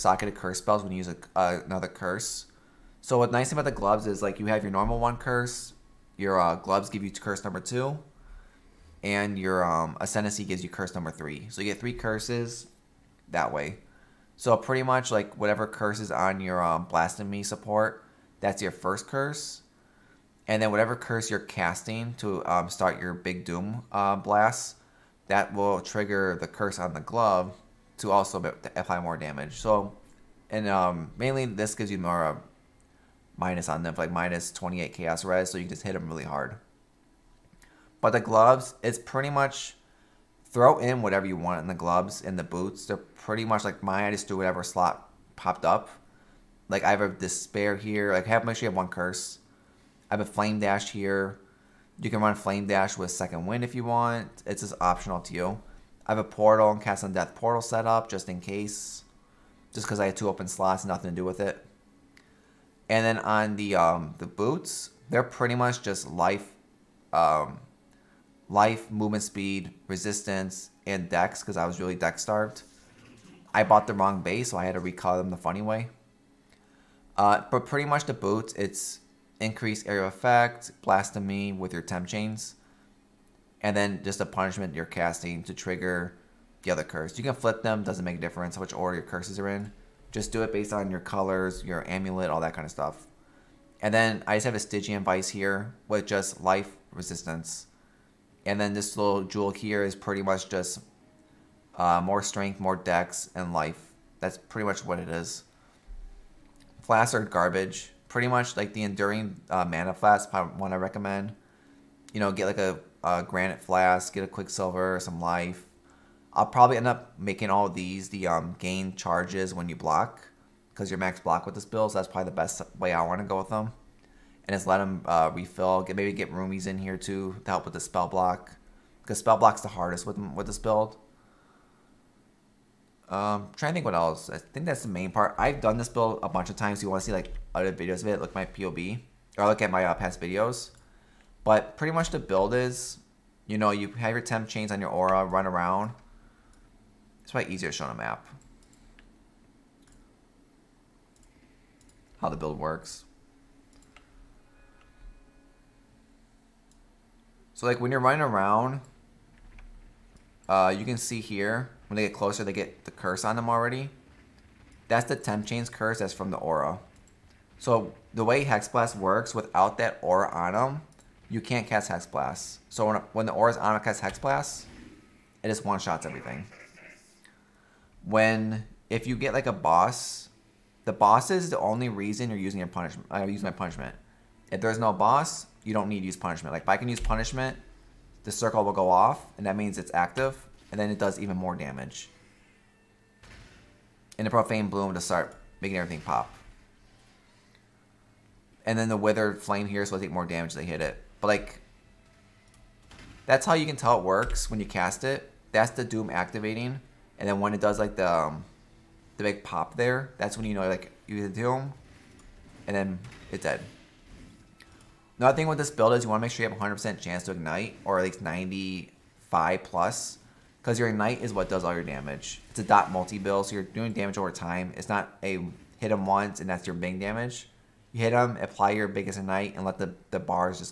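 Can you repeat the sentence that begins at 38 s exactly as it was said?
But the gloves, it's pretty much throw in whatever you want in the gloves and the boots.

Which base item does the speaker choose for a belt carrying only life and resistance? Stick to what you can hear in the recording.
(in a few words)
Stygian Vice.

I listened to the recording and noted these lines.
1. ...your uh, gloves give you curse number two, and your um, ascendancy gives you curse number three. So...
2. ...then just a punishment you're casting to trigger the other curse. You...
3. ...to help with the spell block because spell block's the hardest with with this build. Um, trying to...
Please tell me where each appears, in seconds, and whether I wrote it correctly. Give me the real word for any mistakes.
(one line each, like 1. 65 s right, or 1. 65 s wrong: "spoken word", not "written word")
1. 6 s right
2. 83 s right
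3. 127 s right.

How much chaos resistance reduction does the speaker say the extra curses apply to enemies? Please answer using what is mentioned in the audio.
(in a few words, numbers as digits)
-28.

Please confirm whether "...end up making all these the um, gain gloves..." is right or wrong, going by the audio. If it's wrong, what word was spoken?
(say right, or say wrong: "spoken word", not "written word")
wrong: "charges", not "gloves".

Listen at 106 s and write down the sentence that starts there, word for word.
Flaccid garbage pretty much like the enduring uh, mana flask.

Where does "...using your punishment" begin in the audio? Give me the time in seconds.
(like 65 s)
182 s.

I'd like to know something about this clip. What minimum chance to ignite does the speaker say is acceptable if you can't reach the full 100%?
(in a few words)
95%.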